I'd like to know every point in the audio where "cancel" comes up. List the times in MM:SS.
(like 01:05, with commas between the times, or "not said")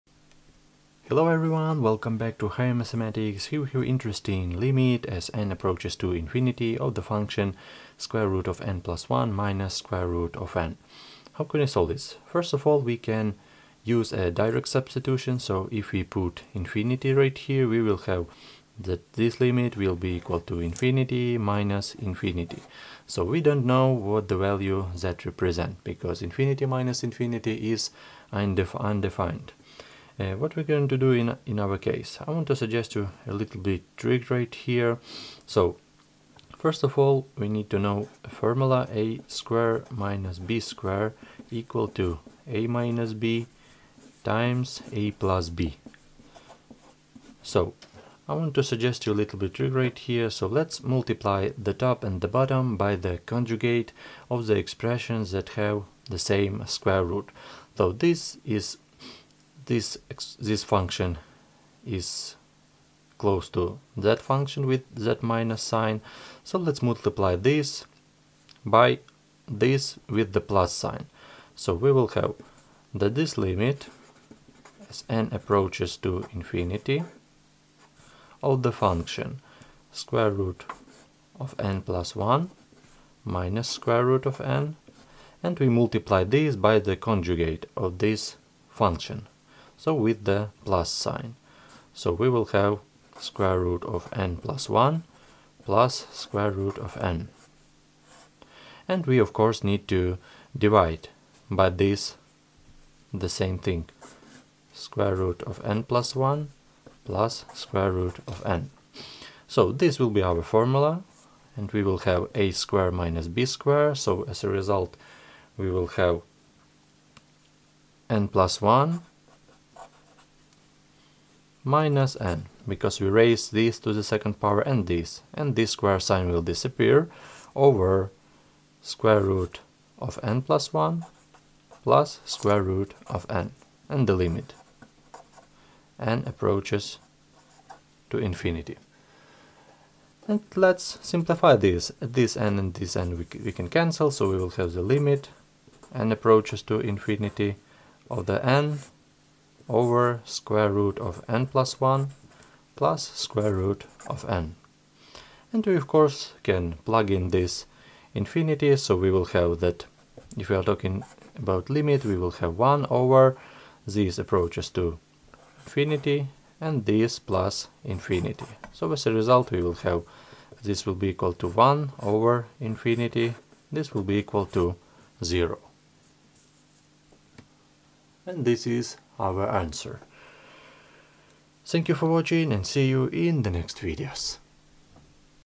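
02:23.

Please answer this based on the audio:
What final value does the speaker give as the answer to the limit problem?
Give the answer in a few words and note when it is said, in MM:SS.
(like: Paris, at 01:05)
0, at 02:55.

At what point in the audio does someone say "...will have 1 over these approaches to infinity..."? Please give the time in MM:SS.
02:42.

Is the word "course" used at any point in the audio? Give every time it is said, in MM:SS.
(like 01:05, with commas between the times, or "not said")
01:39, 02:35.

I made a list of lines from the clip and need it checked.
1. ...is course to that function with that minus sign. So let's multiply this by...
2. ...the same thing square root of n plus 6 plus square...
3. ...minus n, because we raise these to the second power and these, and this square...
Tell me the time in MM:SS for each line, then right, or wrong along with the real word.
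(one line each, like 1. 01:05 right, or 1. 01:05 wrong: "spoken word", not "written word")
1. 01:01 wrong: "close", not "course"
2. 01:43 wrong: "1", not "6"
3. 02:01 right.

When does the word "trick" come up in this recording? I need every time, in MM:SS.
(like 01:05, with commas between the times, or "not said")
00:33, 00:49.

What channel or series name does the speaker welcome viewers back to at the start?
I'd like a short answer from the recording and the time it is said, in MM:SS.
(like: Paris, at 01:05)
Higher Mathematics, at 00:02.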